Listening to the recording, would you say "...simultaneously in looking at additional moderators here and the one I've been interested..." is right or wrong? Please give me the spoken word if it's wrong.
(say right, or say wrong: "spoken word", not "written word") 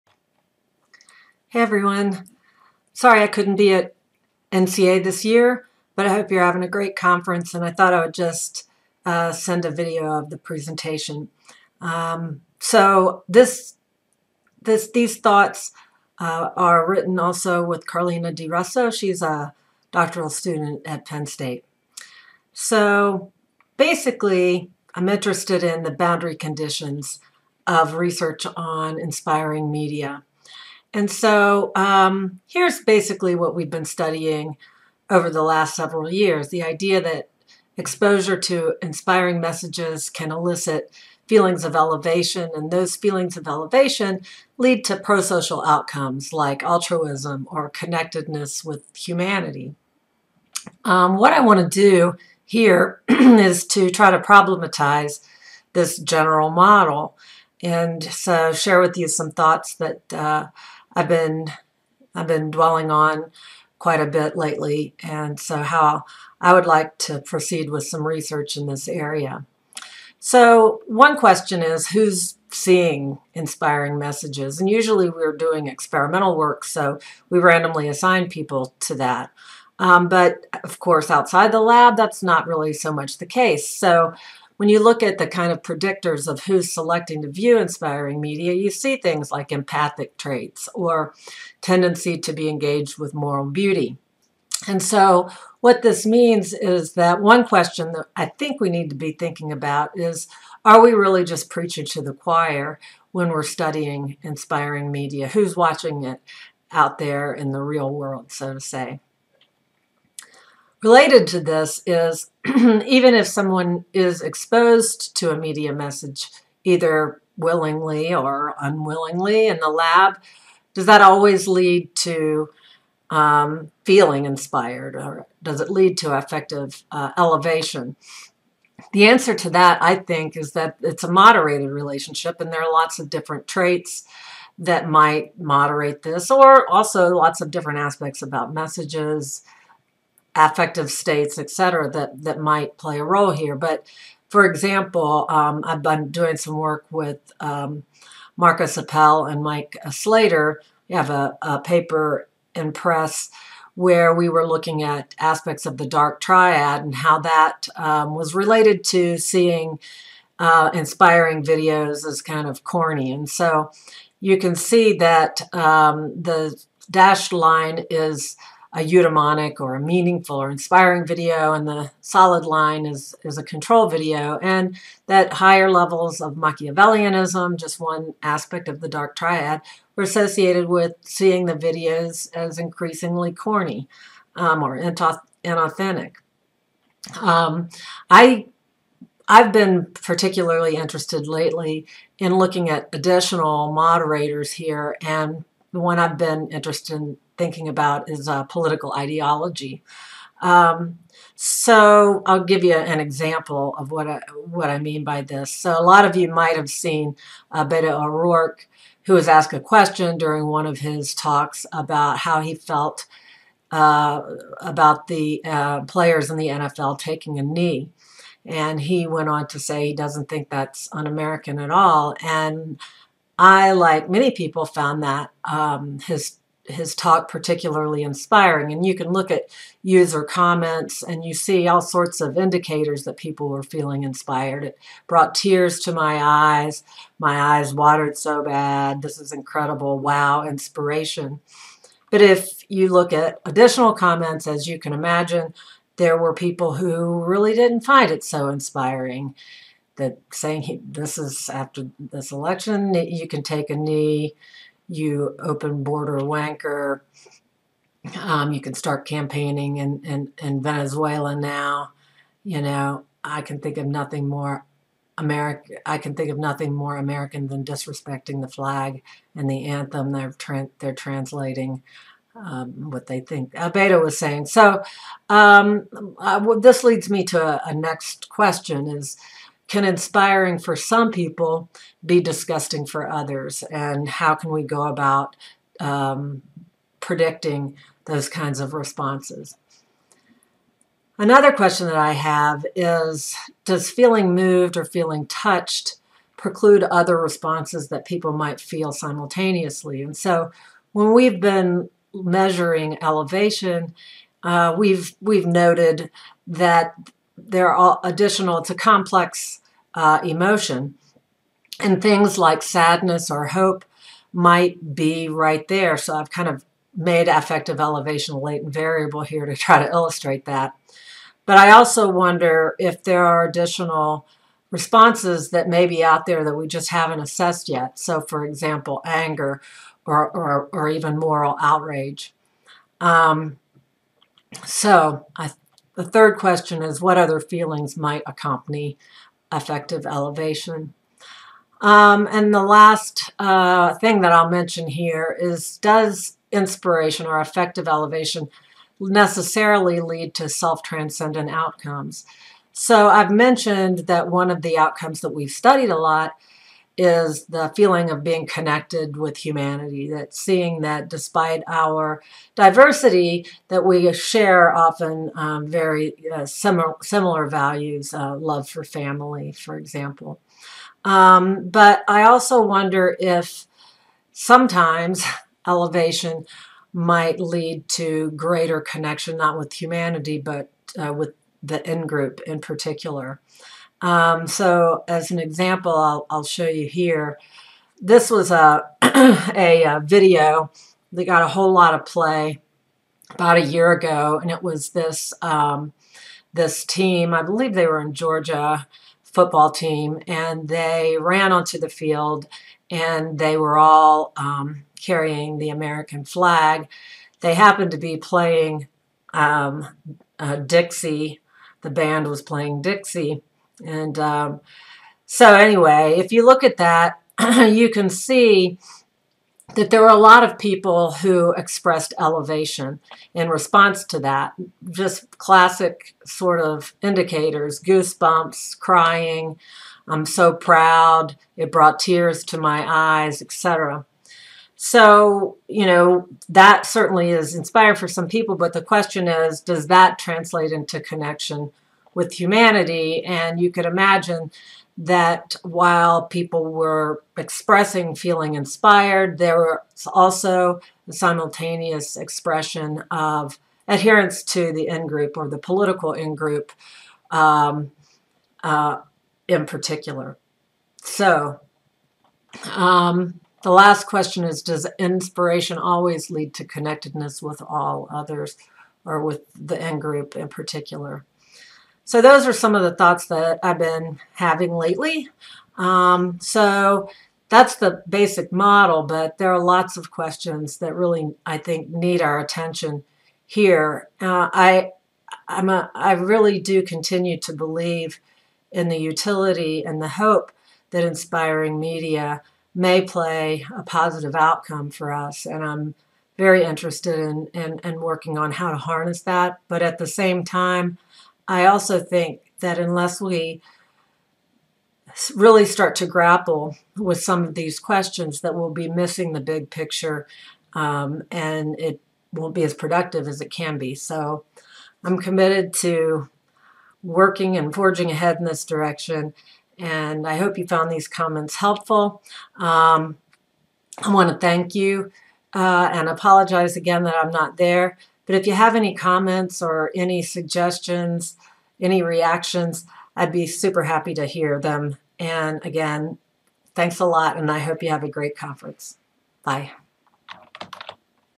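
wrong: "lately", not "simultaneously".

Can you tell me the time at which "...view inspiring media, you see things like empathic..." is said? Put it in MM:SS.
01:27.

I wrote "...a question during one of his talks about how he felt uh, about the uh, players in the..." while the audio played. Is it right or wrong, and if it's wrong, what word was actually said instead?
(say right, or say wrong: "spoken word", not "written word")
right.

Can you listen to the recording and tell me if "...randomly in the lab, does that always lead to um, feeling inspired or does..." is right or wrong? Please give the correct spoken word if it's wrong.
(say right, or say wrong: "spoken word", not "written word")
wrong: "unwillingly", not "randomly".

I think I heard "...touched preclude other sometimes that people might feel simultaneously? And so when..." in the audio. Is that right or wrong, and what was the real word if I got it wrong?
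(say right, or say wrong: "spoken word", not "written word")
wrong: "responses", not "sometimes".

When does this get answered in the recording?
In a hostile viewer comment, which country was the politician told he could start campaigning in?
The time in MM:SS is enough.
04:20.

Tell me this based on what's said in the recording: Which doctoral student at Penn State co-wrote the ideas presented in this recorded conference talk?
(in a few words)
Carlina DiRusso.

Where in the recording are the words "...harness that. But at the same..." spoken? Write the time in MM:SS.
08:18.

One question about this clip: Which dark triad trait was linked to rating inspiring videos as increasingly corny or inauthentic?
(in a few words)
Machiavellianism.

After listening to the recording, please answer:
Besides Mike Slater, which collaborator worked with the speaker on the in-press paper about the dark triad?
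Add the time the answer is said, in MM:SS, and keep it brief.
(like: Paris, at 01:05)
Marcus Appel, at 02:28.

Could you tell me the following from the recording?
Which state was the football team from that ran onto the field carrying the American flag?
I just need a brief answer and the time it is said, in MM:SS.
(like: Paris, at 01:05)
Georgia, at 06:38.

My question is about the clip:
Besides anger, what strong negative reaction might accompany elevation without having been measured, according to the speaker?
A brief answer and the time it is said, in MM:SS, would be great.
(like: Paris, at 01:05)
moral outrage, at 05:31.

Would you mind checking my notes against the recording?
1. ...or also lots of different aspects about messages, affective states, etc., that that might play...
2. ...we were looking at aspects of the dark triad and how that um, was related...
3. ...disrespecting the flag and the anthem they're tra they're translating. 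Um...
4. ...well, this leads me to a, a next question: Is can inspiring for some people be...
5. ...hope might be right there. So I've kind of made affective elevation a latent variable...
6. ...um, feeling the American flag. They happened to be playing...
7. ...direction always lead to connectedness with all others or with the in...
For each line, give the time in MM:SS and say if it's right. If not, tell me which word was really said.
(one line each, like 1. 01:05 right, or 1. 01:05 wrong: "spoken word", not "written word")
1. 02:16 right
2. 02:34 right
3. 04:27 right
4. 04:36 right
5. 05:13 right
6. 06:44 wrong: "carrying", not "feeling"
7. 07:44 wrong: "inspiration", not "direction".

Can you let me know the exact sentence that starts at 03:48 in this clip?
And you can look at user comments and you see all sorts of indicators that people were feeling inspired.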